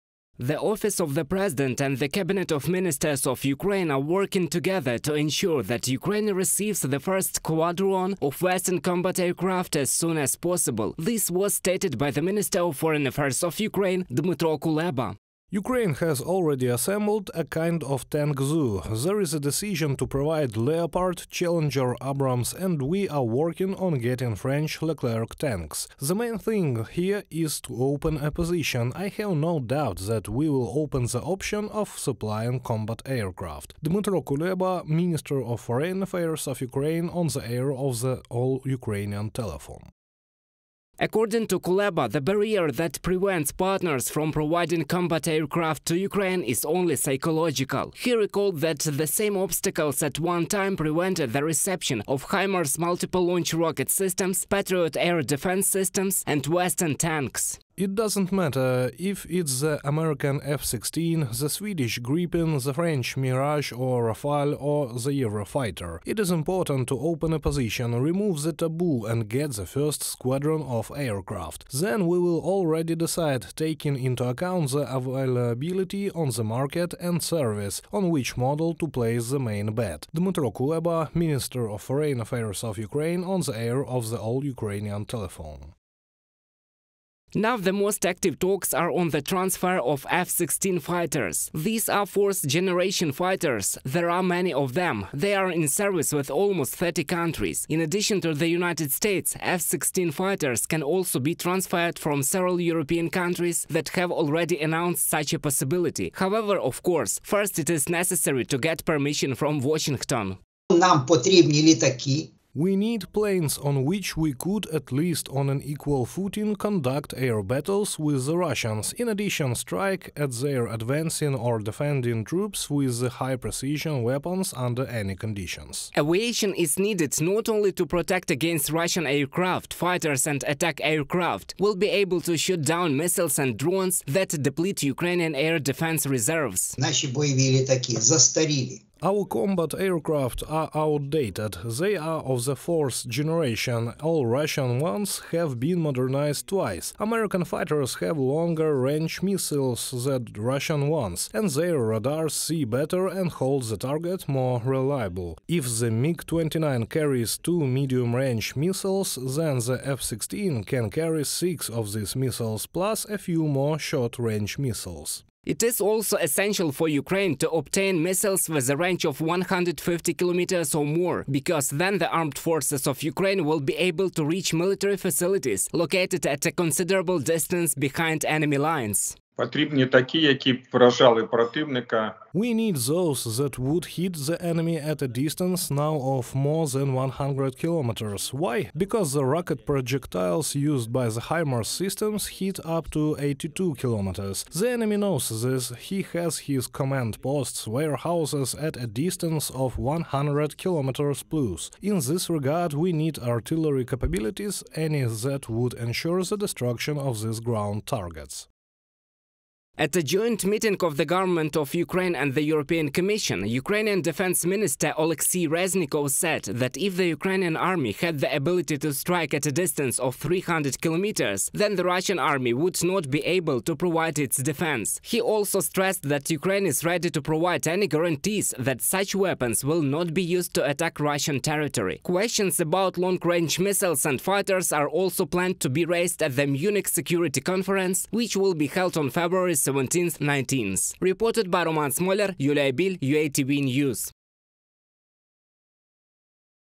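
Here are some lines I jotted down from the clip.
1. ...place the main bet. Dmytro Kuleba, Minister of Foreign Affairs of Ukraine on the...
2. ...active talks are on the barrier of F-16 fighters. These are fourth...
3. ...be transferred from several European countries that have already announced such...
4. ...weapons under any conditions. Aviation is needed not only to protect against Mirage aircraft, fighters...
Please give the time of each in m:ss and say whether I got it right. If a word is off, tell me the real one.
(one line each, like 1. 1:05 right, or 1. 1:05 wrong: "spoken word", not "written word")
1. 1:18 right
2. 1:28 wrong: "transfer", not "barrier"
3. 1:41 right
4. 2:04 wrong: "Russian", not "Mirage".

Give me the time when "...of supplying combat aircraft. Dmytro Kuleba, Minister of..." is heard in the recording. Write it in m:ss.
0:31.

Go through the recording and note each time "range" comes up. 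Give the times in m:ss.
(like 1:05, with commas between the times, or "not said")
2:28, 2:37, 2:43, 2:48, 3:52.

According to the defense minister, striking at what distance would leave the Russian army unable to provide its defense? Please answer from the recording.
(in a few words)
300 kilometers.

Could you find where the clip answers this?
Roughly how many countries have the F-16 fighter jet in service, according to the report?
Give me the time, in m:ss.
1:36.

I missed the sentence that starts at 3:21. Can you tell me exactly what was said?
In this regard, we need artillery capabilities, any that would ensure the destruction of these ground targets.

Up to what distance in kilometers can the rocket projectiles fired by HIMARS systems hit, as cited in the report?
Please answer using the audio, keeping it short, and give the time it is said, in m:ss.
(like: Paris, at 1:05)
82 kilometers, at 3:13.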